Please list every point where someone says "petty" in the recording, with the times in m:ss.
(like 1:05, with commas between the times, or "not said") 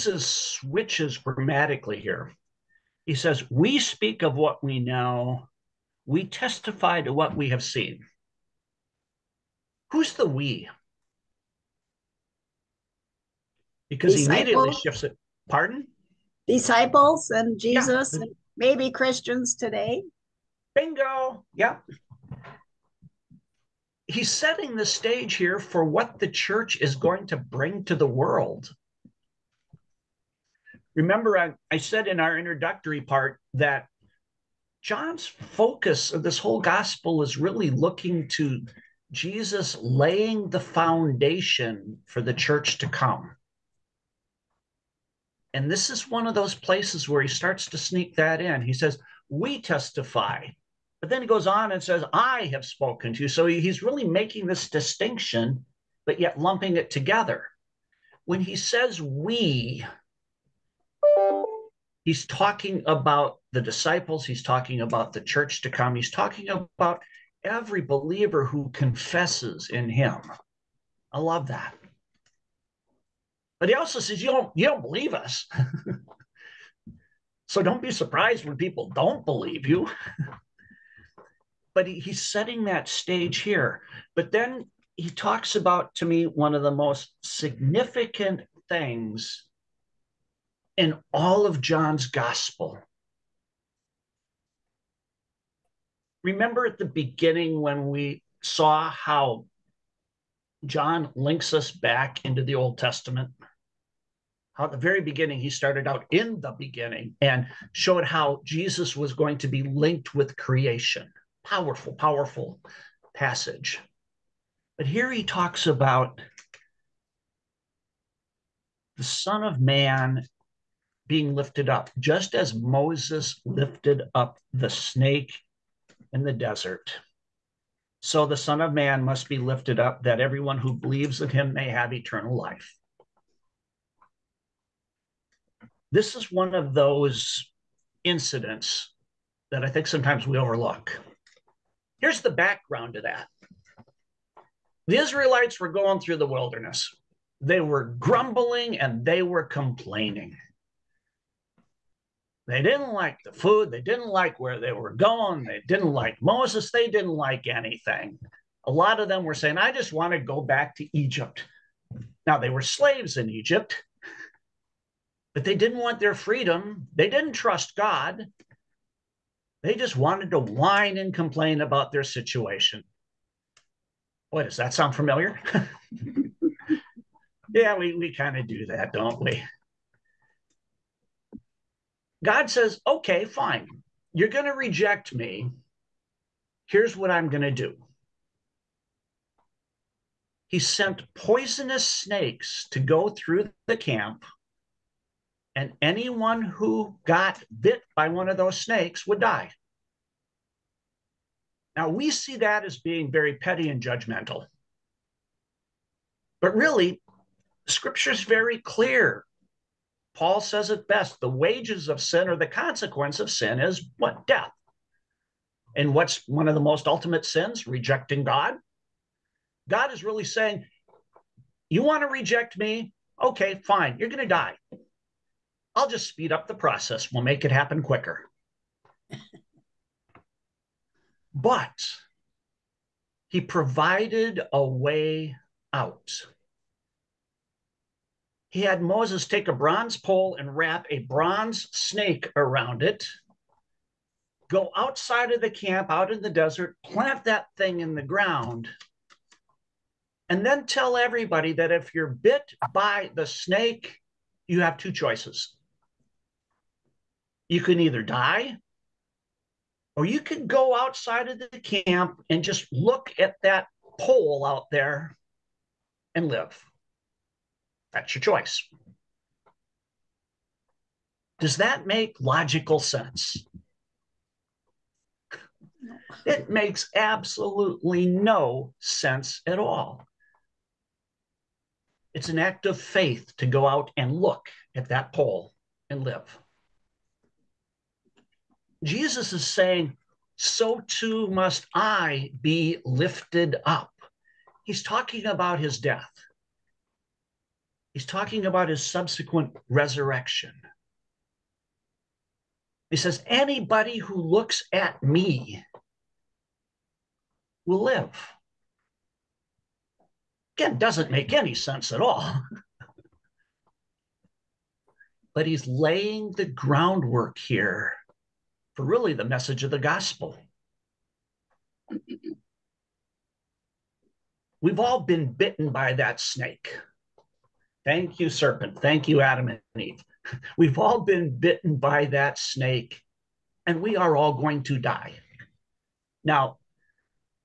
3:23.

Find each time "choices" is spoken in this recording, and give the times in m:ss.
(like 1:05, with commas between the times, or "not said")
4:14, 4:28.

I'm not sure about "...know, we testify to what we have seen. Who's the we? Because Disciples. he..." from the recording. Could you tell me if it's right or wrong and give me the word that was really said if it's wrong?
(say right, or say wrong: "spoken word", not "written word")
right.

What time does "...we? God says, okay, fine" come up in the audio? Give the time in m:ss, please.
2:59.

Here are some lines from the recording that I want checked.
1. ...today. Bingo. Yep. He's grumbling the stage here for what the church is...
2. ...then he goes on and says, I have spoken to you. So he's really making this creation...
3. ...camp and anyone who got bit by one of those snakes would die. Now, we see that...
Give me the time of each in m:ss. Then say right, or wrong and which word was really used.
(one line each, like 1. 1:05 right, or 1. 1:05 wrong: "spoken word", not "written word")
1. 0:19 wrong: "setting", not "grumbling"
2. 0:51 wrong: "distinction", not "creation"
3. 3:13 right.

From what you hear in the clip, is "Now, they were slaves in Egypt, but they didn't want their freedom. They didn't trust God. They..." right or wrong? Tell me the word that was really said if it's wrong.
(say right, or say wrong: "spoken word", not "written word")
right.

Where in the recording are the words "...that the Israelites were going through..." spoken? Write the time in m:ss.
2:23.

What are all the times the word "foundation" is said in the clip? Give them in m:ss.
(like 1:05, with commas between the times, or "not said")
0:40.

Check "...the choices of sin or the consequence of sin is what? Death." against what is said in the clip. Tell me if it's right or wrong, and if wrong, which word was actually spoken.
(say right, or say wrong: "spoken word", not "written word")
wrong: "wages", not "choices".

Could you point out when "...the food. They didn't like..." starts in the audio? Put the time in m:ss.
2:33.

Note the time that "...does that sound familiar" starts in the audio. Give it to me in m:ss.
2:54.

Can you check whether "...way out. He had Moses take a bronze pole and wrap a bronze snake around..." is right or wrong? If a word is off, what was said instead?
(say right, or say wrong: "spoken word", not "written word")
right.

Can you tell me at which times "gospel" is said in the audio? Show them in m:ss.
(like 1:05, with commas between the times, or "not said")
0:36, 1:32, 5:19.